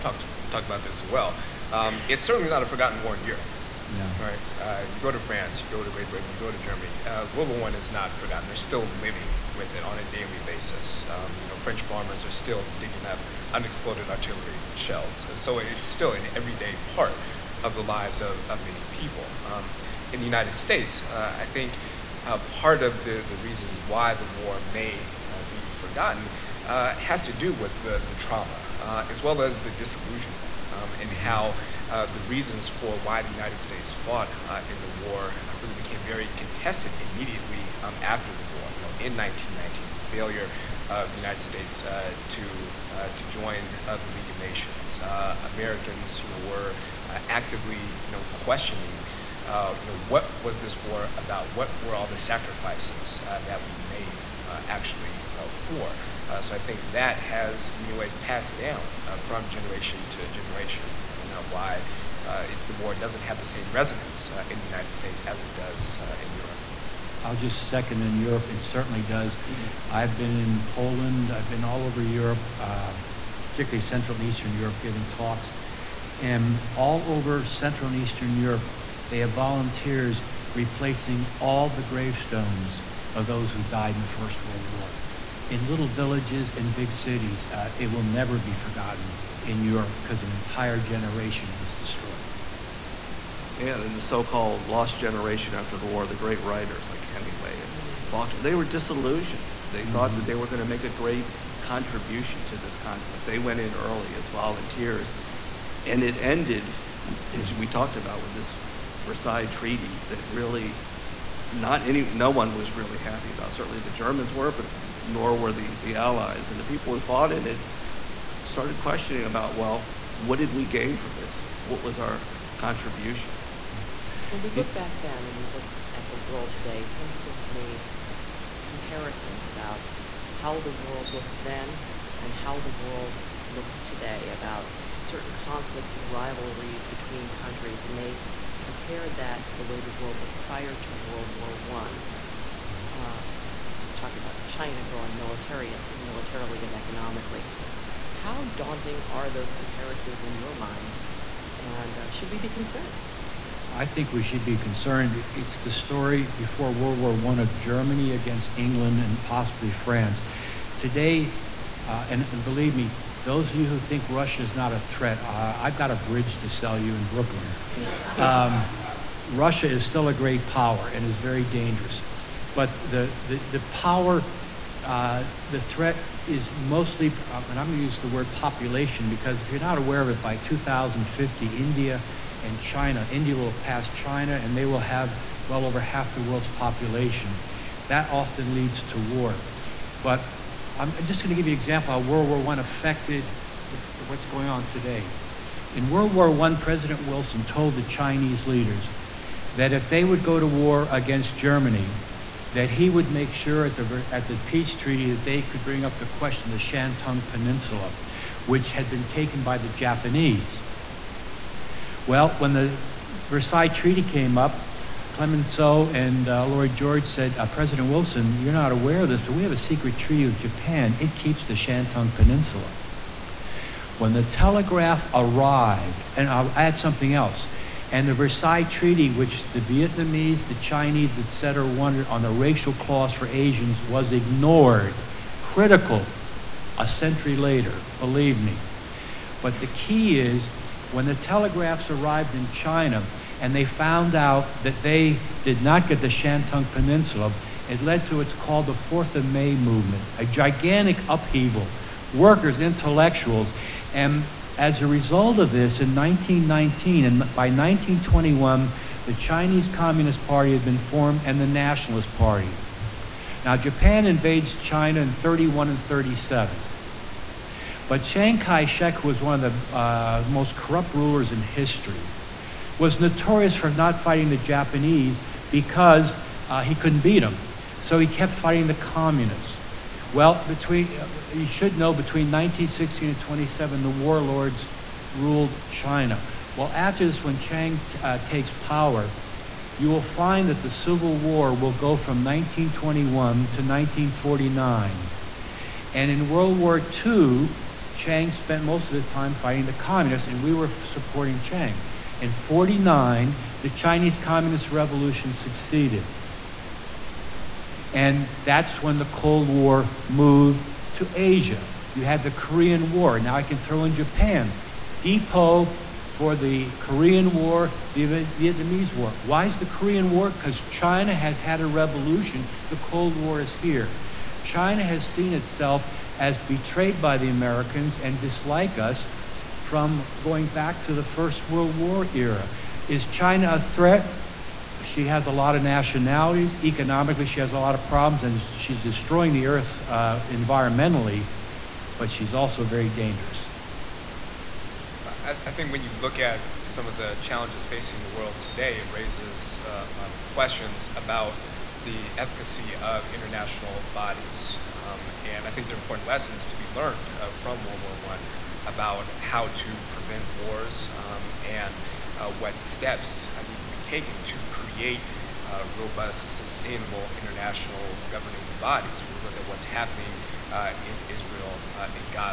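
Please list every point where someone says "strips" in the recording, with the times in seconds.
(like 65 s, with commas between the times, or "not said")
not said.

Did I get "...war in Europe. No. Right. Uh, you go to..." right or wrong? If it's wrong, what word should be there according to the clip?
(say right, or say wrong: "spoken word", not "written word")
right.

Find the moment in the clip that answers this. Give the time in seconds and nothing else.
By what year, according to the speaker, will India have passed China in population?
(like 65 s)
180 s.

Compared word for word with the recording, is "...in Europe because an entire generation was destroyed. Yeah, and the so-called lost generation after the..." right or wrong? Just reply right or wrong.
right.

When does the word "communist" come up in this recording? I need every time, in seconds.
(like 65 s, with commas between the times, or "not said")
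259 s, 278 s, 299 s, 304 s.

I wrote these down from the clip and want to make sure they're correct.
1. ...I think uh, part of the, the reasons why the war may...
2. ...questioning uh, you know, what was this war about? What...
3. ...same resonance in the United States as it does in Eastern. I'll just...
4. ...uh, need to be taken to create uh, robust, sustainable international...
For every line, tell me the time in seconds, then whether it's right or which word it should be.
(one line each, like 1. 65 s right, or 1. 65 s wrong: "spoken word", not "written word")
1. 21 s right
2. 48 s right
3. 63 s wrong: "Europe", not "Eastern"
4. 363 s right.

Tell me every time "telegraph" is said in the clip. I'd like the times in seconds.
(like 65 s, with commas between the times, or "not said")
224 s, 241 s.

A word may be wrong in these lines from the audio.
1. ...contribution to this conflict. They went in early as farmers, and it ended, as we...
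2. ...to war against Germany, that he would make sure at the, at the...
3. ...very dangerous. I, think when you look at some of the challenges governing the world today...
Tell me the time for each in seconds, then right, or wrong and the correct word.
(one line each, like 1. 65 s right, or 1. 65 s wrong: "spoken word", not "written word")
1. 101 s wrong: "volunteers", not "farmers"
2. 200 s right
3. 342 s wrong: "facing", not "governing".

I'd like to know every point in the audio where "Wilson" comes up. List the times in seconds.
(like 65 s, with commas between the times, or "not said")
197 s, 217 s.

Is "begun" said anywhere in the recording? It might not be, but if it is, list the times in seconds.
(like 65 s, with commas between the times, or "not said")
not said.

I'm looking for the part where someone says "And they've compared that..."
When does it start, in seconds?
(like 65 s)
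137 s.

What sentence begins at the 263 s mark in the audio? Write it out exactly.
Now, Japan invades China in 31 and 37.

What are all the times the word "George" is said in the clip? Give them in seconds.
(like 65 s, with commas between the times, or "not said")
216 s.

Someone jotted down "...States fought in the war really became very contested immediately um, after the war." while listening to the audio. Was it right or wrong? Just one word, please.
right.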